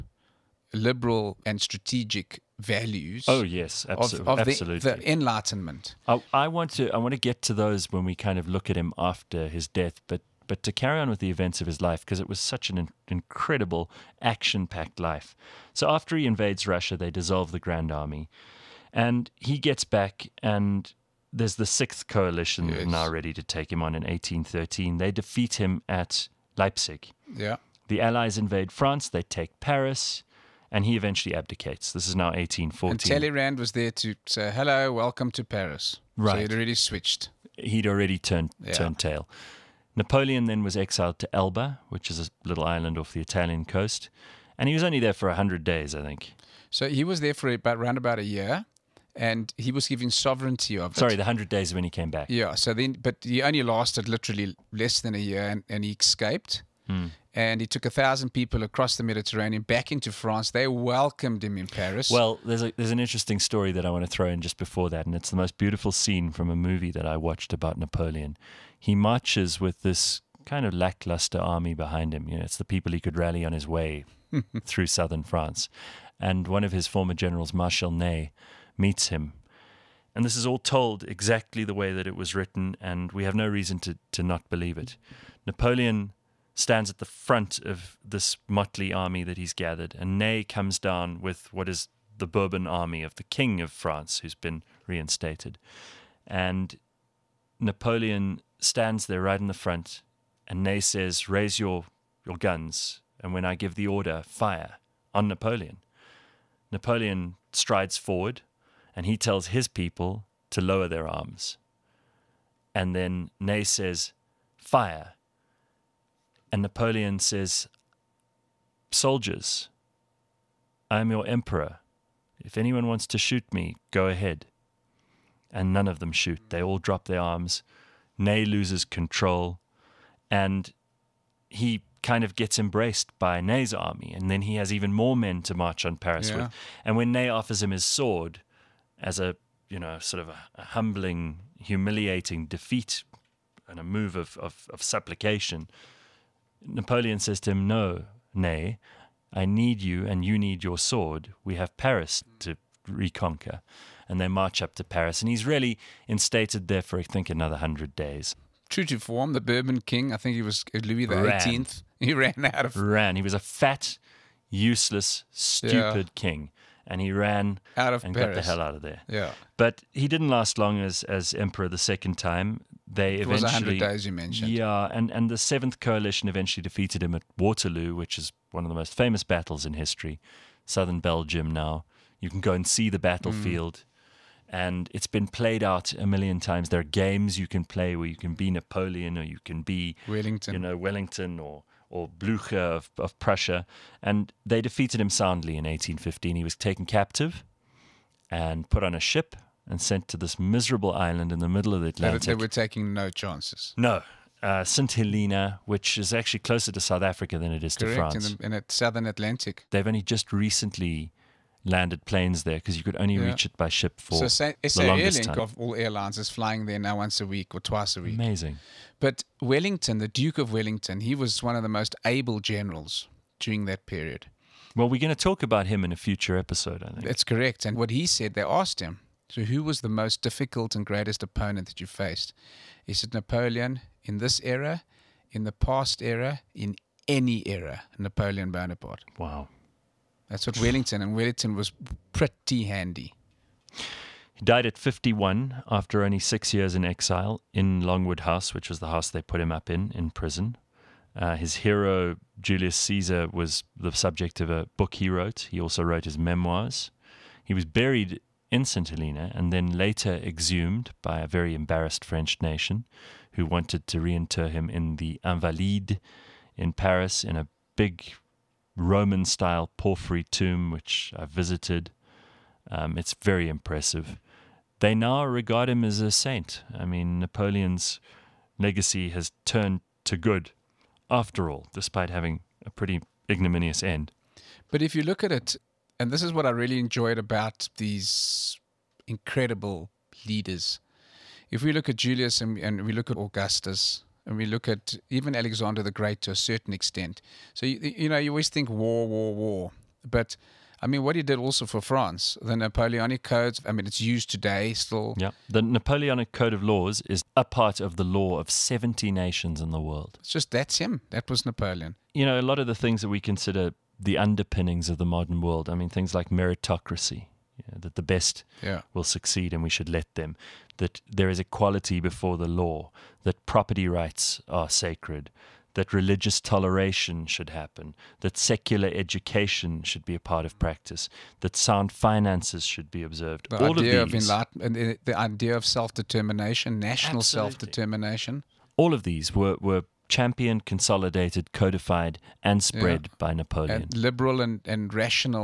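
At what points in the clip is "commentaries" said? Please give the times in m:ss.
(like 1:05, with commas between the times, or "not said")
not said.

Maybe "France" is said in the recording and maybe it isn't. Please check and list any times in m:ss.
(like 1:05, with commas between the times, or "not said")
0:28, 1:00, 1:15, 1:33, 3:28, 5:01.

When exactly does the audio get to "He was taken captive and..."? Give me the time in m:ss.
3:16.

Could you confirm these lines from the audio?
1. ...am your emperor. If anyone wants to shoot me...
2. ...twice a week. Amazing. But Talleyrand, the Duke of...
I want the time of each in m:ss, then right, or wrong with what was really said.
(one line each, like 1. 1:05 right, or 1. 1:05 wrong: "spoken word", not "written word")
1. 2:00 right
2. 3:37 wrong: "Wellington", not "Talleyrand".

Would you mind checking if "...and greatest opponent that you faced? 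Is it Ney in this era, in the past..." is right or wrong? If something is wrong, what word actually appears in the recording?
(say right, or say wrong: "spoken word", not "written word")
wrong: "Napoleon", not "Ney".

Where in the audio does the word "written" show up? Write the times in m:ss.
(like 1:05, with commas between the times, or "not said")
1:22.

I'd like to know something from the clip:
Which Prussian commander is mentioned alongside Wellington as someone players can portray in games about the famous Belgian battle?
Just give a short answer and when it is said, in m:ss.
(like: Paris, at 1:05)
Blucher, at 3:12.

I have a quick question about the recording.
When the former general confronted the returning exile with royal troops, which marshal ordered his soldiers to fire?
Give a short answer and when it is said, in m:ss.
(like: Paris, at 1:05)
Marshal Ney, at 1:17.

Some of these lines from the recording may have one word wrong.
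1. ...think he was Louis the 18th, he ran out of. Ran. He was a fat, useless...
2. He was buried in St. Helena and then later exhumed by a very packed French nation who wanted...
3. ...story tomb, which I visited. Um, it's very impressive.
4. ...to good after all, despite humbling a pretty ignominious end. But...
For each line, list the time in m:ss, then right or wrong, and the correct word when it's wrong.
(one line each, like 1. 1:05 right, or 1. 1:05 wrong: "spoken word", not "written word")
1. 2:40 right
2. 4:17 wrong: "embarrassed", not "packed"
3. 4:29 wrong: "porphyry", not "story"
4. 4:40 wrong: "having", not "humbling".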